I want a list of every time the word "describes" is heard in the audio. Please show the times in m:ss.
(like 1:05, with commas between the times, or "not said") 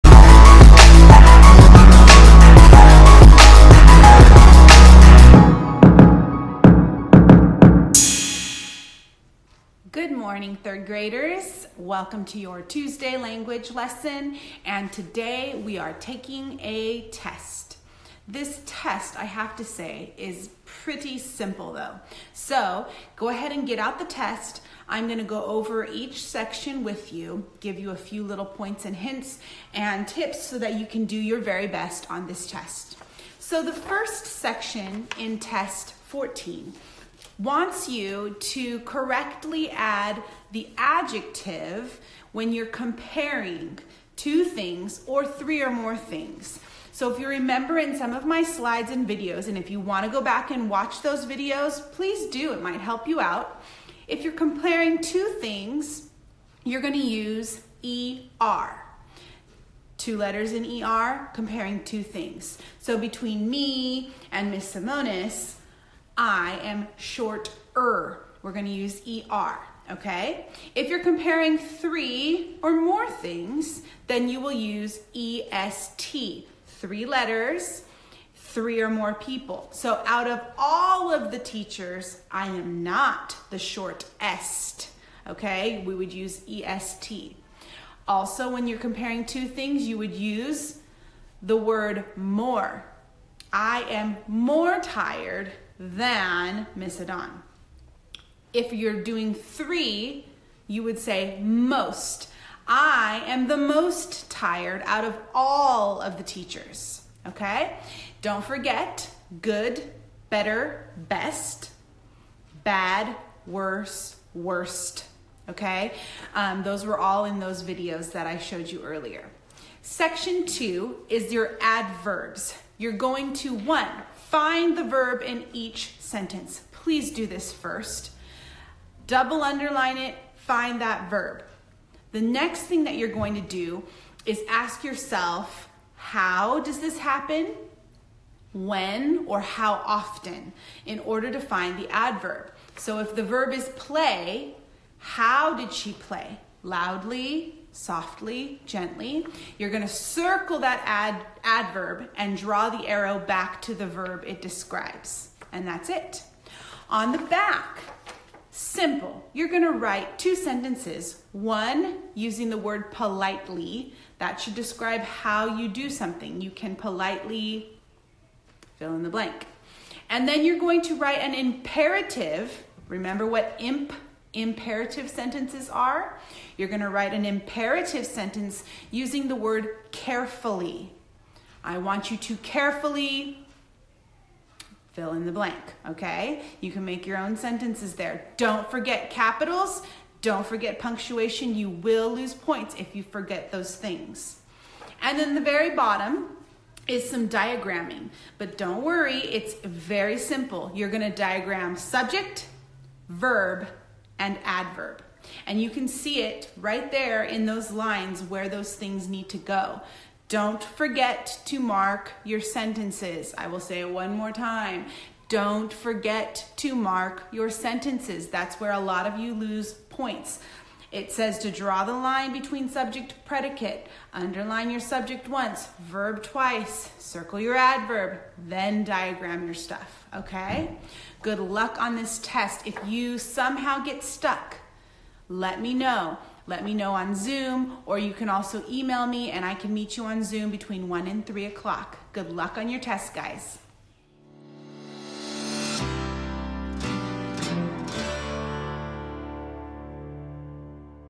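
2:34, 2:44.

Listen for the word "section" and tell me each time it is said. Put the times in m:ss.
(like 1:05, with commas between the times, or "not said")
0:26, 0:34, 1:59.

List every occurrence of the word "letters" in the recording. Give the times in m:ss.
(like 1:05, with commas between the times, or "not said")
1:00, 1:17.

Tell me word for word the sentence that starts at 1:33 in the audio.
I am more tired than Misodon.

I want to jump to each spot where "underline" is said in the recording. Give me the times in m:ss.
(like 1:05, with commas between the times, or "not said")
2:09, 3:44.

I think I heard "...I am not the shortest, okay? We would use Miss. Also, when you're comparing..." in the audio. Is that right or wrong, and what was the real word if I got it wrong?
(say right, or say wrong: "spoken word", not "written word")
wrong: "EST", not "Miss".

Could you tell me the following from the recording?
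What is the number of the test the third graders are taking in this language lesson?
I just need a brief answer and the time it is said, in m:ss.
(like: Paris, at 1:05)
14, at 0:35.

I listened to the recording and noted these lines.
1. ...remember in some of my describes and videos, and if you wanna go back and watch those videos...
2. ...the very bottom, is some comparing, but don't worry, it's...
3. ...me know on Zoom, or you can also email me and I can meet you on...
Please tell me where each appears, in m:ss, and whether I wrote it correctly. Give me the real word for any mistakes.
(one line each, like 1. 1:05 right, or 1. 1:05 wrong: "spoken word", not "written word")
1. 0:47 wrong: "slides", not "describes"
2. 3:15 wrong: "diagramming", not "comparing"
3. 3:56 right.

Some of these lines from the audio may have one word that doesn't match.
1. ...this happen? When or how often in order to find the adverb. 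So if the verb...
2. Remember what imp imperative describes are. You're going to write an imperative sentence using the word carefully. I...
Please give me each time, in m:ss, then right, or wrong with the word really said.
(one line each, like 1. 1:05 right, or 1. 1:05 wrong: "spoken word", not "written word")
1. 2:16 right
2. 2:52 wrong: "sentences", not "describes".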